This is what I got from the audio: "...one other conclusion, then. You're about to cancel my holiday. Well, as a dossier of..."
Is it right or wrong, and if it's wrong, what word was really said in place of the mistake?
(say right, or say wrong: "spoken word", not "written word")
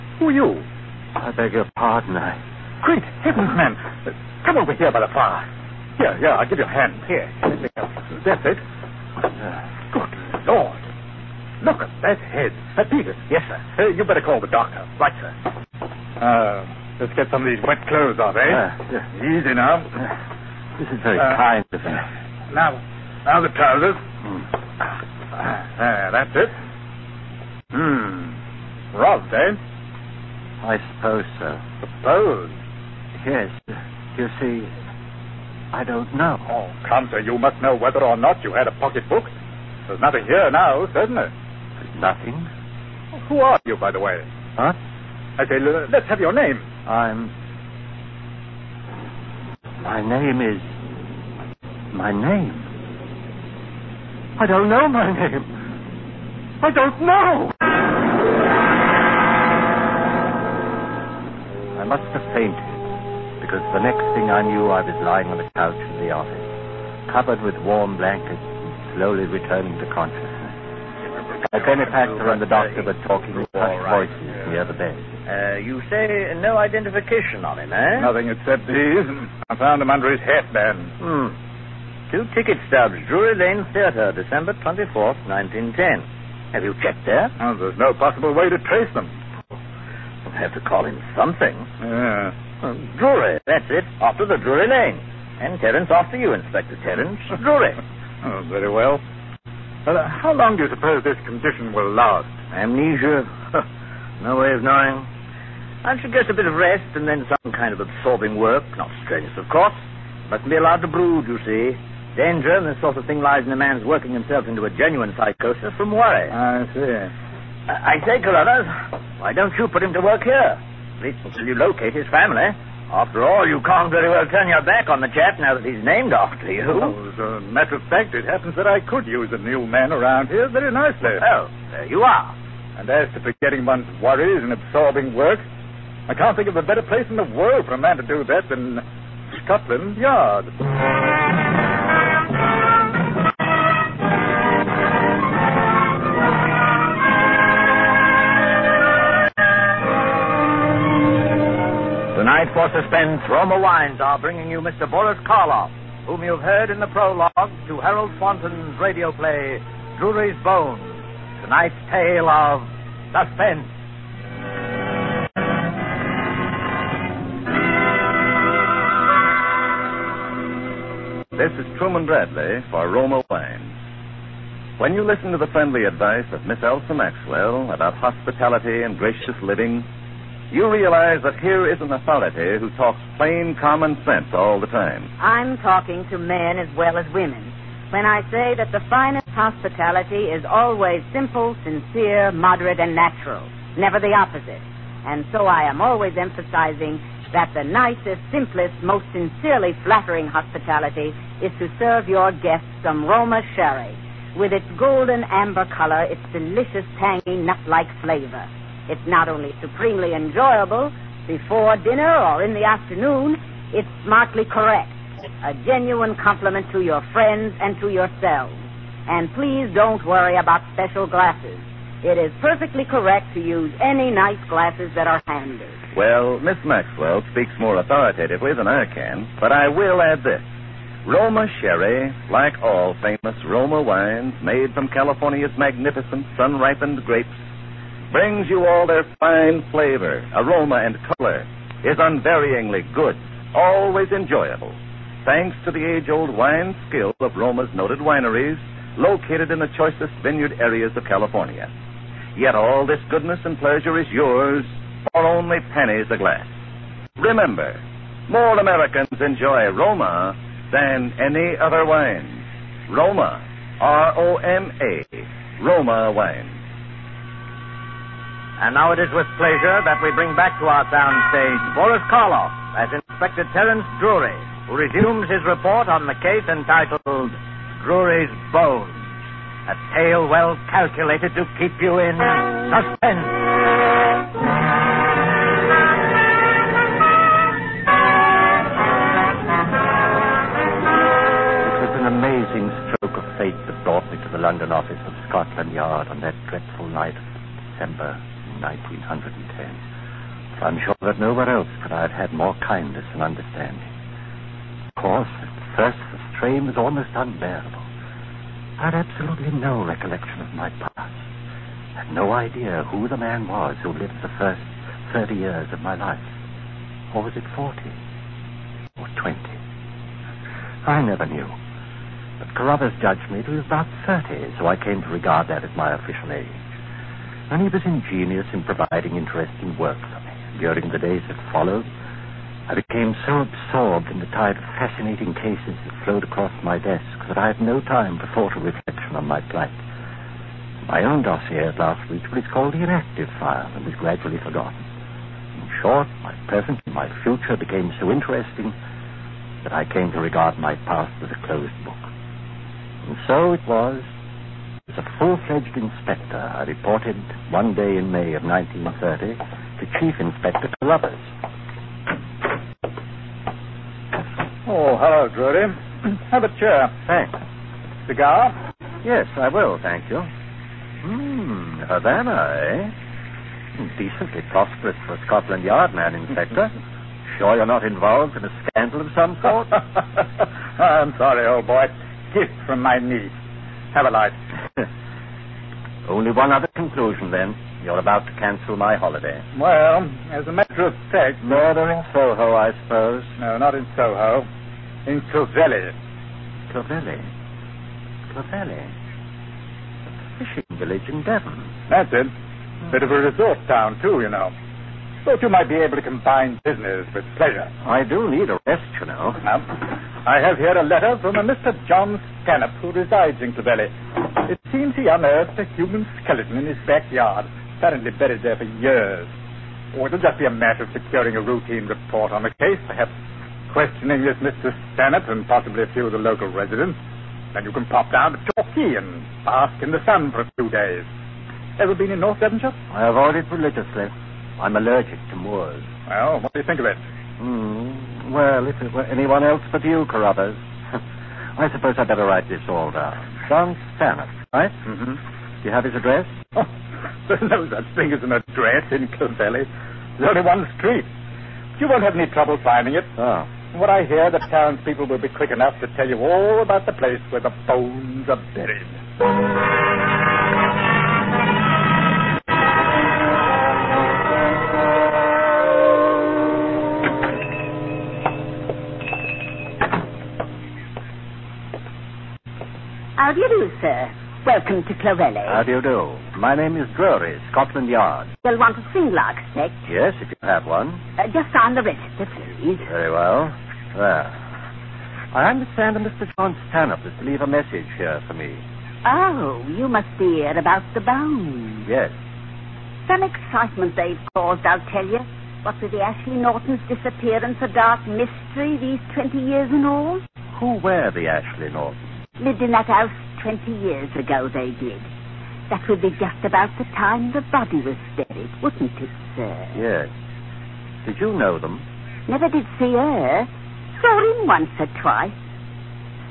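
wrong: "matter", not "dossier".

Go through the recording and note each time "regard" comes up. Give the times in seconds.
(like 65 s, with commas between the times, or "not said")
325 s, 350 s.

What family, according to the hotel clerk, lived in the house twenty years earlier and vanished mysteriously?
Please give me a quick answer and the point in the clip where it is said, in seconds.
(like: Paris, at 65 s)
the Ashley Nortons, at 495 s.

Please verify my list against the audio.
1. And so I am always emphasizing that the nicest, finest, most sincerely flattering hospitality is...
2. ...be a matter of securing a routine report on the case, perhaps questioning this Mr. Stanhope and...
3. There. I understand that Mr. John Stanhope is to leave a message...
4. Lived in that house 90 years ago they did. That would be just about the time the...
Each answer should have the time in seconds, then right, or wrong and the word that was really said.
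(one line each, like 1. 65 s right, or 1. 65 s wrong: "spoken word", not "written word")
1. 195 s wrong: "simplest", not "finest"
2. 420 s right
3. 483 s right
4. 502 s wrong: "20", not "90".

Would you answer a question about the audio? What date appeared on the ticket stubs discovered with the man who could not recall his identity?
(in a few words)
December 24th, 1910.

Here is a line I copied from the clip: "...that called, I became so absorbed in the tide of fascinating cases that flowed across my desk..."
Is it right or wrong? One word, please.
wrong.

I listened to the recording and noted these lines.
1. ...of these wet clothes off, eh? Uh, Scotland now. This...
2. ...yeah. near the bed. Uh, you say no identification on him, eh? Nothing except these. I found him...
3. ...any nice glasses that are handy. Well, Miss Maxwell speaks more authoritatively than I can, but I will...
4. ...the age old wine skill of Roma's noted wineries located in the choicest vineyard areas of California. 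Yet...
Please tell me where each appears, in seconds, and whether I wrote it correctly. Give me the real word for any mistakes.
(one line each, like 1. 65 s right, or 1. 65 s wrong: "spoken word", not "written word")
1. 17 s wrong: "Easy", not "Scotland"
2. 74 s right
3. 223 s right
4. 245 s right.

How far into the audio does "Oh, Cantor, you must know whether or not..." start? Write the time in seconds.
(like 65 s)
36 s.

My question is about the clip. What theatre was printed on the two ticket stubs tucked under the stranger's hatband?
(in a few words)
Drury Lane Theatre.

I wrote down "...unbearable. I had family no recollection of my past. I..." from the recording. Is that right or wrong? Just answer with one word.
wrong.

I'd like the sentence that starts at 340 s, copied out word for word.
My own dossier at last reached what is called the inactive file and was gradually forgotten.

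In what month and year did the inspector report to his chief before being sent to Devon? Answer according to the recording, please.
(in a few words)
May 1930.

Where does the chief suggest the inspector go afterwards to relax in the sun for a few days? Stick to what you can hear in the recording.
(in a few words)
Torquay.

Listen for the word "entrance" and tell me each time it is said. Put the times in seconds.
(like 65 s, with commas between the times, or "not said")
not said.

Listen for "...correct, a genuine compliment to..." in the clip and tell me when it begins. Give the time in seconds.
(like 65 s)
214 s.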